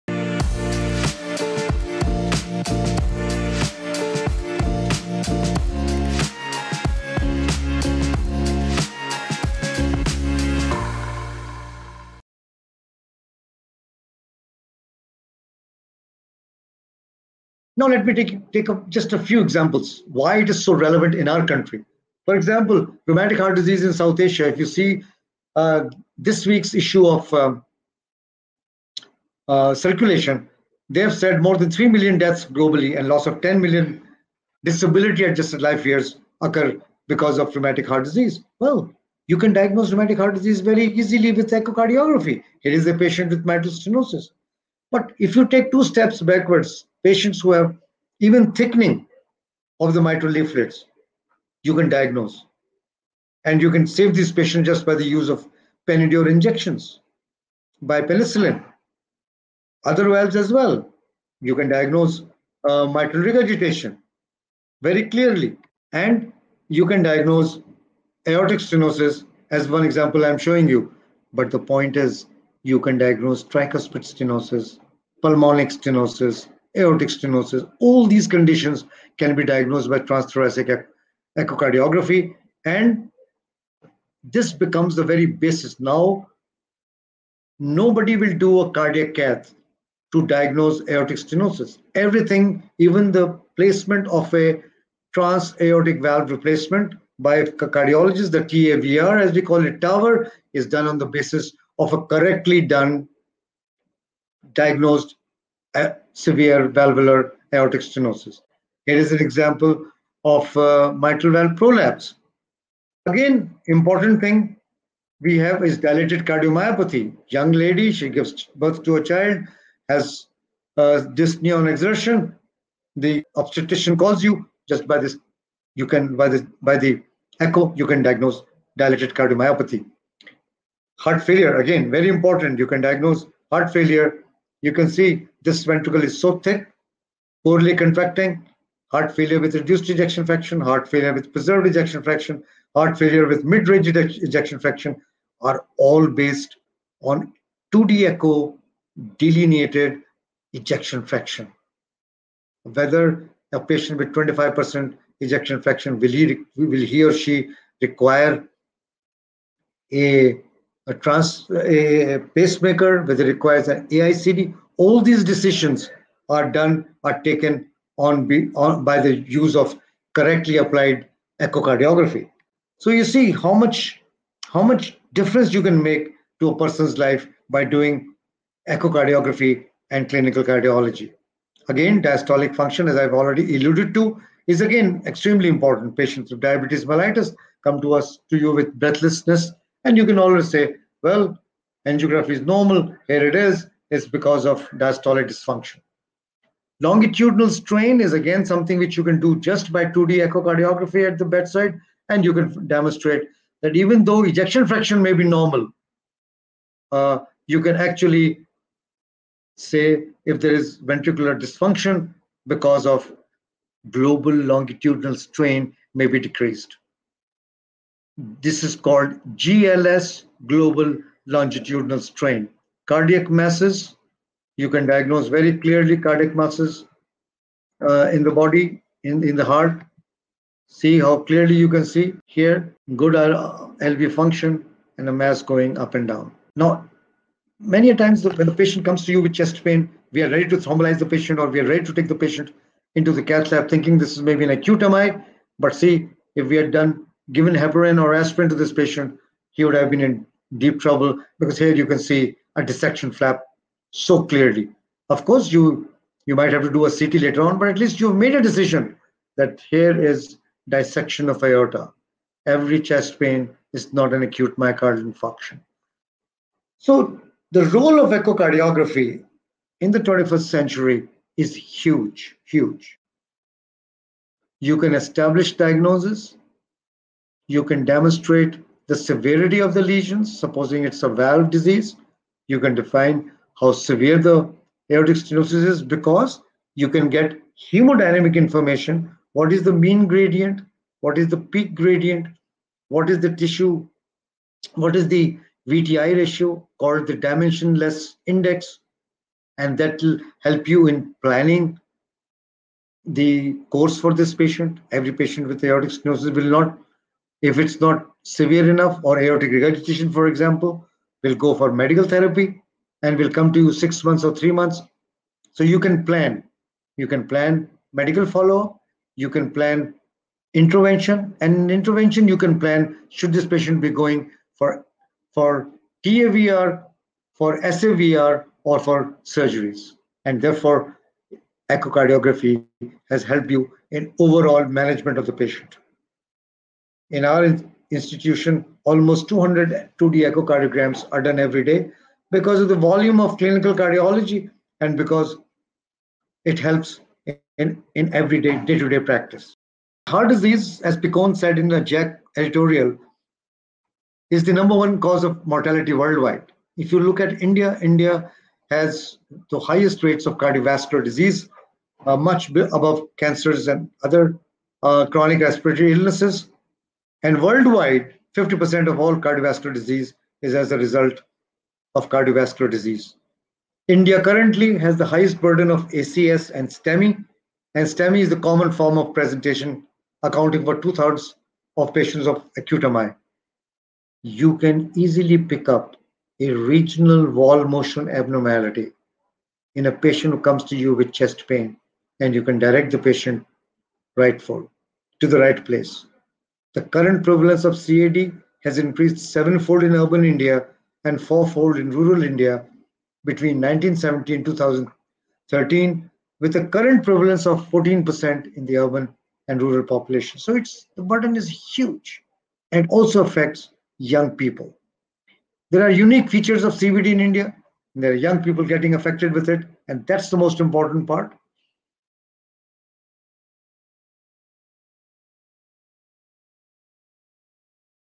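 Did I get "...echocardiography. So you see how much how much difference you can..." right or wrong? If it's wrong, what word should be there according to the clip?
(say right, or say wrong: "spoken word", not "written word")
right.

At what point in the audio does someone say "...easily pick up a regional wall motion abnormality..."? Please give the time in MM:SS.
06:24.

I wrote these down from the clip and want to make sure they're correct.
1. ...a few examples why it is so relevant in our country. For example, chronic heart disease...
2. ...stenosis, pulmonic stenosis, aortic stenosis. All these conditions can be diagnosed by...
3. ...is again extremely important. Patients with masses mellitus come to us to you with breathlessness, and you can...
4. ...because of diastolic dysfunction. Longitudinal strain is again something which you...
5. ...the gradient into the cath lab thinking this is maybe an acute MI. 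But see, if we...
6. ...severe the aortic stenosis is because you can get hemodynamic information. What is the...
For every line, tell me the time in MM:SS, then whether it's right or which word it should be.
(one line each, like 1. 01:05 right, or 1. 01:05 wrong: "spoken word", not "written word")
1. 00:19 wrong: "rheumatic", not "chronic"
2. 01:14 right
3. 03:04 wrong: "diabetes", not "masses"
4. 03:14 right
5. 04:02 wrong: "patient", not "gradient"
6. 04:43 right.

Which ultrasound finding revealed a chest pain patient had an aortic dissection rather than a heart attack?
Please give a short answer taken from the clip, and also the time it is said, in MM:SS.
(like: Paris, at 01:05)
dissection flap, at 04:12.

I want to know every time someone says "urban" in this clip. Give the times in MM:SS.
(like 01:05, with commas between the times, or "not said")
06:39, 06:48.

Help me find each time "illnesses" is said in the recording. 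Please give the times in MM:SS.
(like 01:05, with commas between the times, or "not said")
06:05.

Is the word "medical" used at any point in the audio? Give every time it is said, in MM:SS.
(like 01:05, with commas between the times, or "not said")
05:11, 05:17.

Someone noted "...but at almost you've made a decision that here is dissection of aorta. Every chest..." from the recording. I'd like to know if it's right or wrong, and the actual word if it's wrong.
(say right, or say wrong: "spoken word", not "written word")
wrong: "least", not "almost".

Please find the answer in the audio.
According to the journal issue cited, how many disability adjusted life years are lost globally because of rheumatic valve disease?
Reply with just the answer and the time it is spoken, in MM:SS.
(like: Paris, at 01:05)
10 million, at 00:33.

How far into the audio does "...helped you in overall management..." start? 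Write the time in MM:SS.
05:33.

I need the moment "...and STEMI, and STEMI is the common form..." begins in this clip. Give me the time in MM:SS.
06:16.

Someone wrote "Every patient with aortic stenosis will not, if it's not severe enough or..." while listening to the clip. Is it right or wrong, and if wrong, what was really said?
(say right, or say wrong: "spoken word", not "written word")
right.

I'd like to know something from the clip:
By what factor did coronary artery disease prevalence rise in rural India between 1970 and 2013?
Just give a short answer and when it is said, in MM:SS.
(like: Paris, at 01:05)
fourfold, at 06:41.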